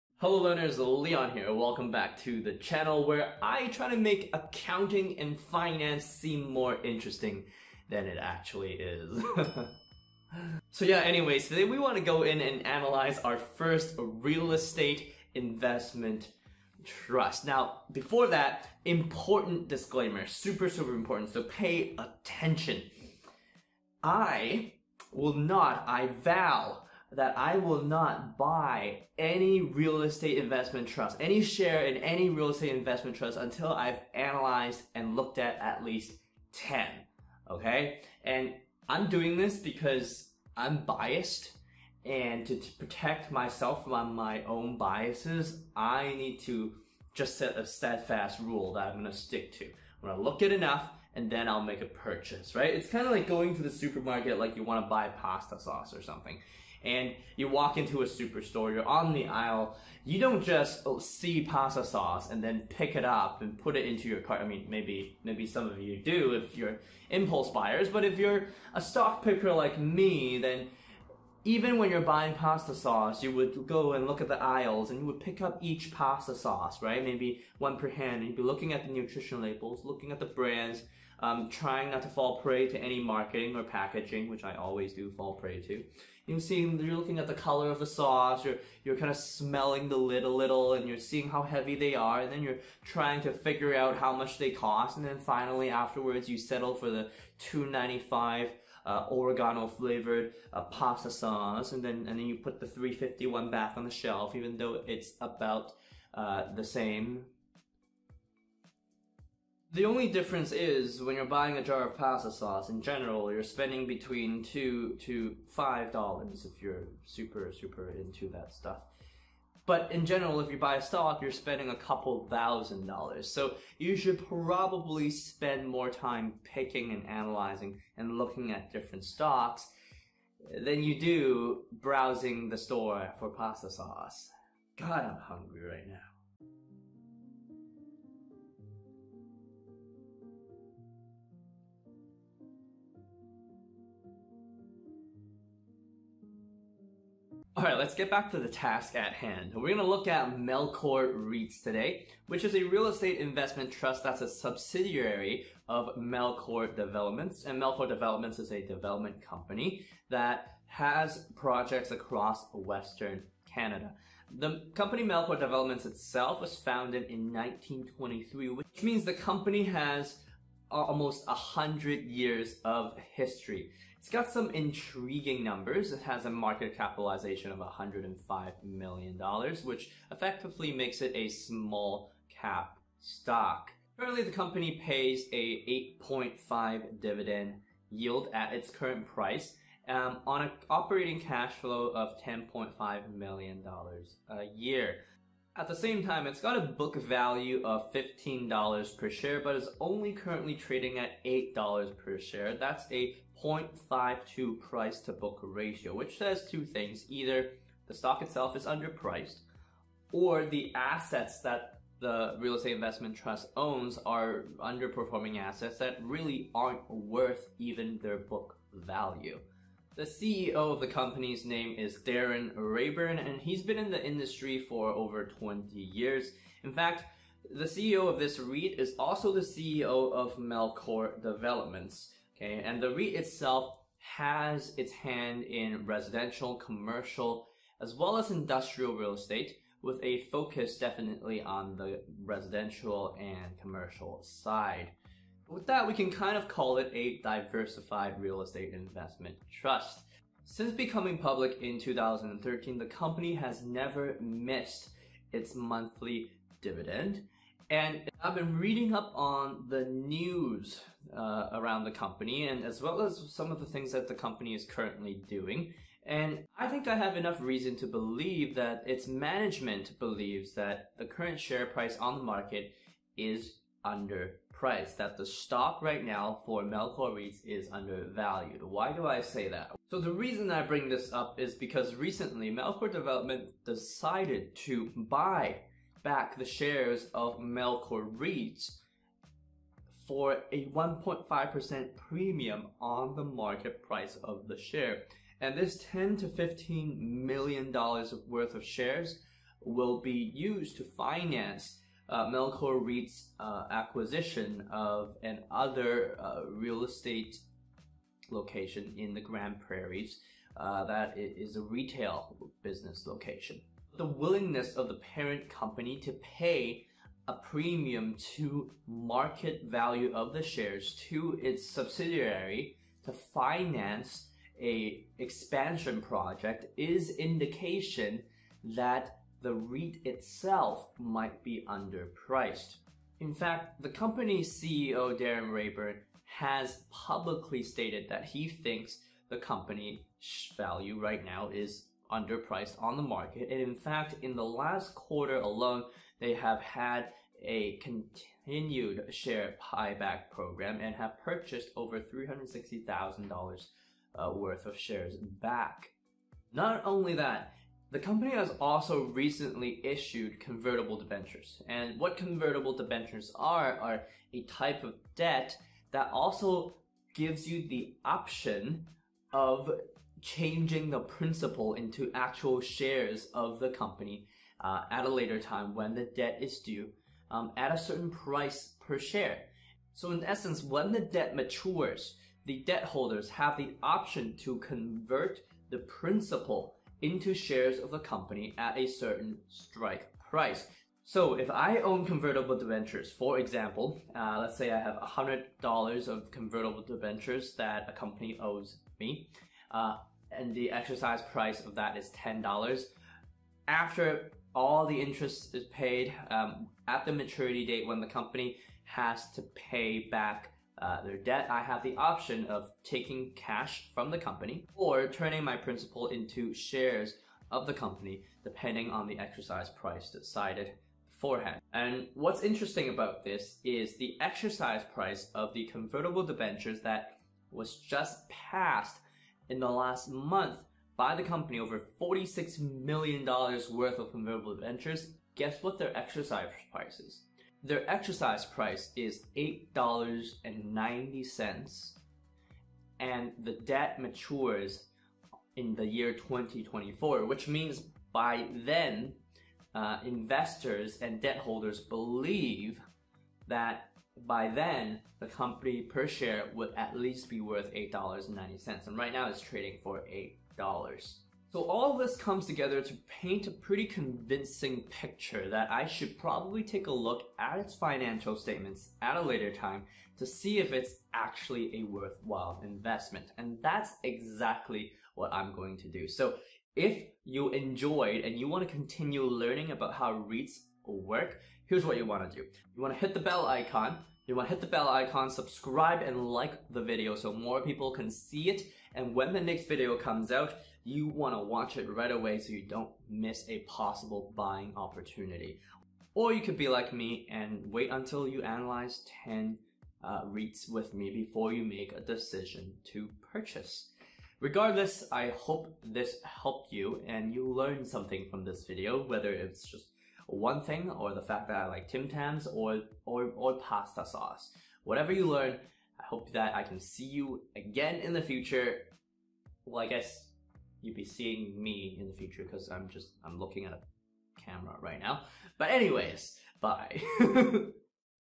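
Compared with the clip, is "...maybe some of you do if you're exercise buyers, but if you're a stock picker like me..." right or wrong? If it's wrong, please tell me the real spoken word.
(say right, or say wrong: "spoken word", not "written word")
wrong: "impulse", not "exercise".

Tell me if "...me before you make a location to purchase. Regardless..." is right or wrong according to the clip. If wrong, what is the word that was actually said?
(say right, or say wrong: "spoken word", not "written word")
wrong: "decision", not "location".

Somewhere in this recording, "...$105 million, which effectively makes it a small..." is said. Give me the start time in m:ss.
2:57.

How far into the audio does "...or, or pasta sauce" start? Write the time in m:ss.
8:33.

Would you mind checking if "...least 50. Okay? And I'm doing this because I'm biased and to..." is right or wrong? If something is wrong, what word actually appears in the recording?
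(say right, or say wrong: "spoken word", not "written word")
wrong: "10", not "50".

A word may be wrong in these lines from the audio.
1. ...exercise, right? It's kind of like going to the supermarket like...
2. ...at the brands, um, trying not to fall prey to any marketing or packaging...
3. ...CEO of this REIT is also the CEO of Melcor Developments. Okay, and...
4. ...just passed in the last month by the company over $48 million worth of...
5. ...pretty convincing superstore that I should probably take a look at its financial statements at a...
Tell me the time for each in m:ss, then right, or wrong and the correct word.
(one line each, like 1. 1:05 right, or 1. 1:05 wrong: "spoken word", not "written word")
1. 0:51 wrong: "purchase", not "exercise"
2. 1:20 right
3. 3:47 right
4. 7:07 wrong: "46", not "48"
5. 7:43 wrong: "picture", not "superstore".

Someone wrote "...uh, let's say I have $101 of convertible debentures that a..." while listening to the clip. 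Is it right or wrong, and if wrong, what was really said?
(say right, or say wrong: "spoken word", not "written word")
wrong: "100", not "101".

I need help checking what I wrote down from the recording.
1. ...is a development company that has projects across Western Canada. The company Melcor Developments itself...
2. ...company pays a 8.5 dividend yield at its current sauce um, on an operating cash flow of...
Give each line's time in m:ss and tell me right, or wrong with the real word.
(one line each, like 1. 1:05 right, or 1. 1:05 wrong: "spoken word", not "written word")
1. 2:38 right
2. 3:04 wrong: "price", not "sauce".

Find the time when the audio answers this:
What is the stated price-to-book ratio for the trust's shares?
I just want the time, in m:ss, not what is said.
3:23.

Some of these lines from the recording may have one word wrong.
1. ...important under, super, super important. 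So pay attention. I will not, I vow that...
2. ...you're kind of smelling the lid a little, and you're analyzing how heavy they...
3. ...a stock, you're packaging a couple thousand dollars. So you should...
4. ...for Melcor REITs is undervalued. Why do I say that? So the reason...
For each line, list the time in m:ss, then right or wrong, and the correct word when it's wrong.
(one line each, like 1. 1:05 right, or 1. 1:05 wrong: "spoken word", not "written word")
1. 0:18 wrong: "disclaimer", not "under"
2. 1:28 wrong: "seeing", not "analyzing"
3. 2:00 wrong: "spending", not "packaging"
4. 4:36 right.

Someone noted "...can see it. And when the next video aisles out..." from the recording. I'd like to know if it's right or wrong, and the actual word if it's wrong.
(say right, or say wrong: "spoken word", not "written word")
wrong: "comes", not "aisles".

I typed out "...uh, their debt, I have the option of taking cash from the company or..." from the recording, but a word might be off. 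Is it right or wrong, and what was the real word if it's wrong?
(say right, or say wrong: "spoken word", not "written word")
right.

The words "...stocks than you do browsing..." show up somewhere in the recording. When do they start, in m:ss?
2:09.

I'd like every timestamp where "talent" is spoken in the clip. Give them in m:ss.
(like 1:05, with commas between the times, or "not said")
not said.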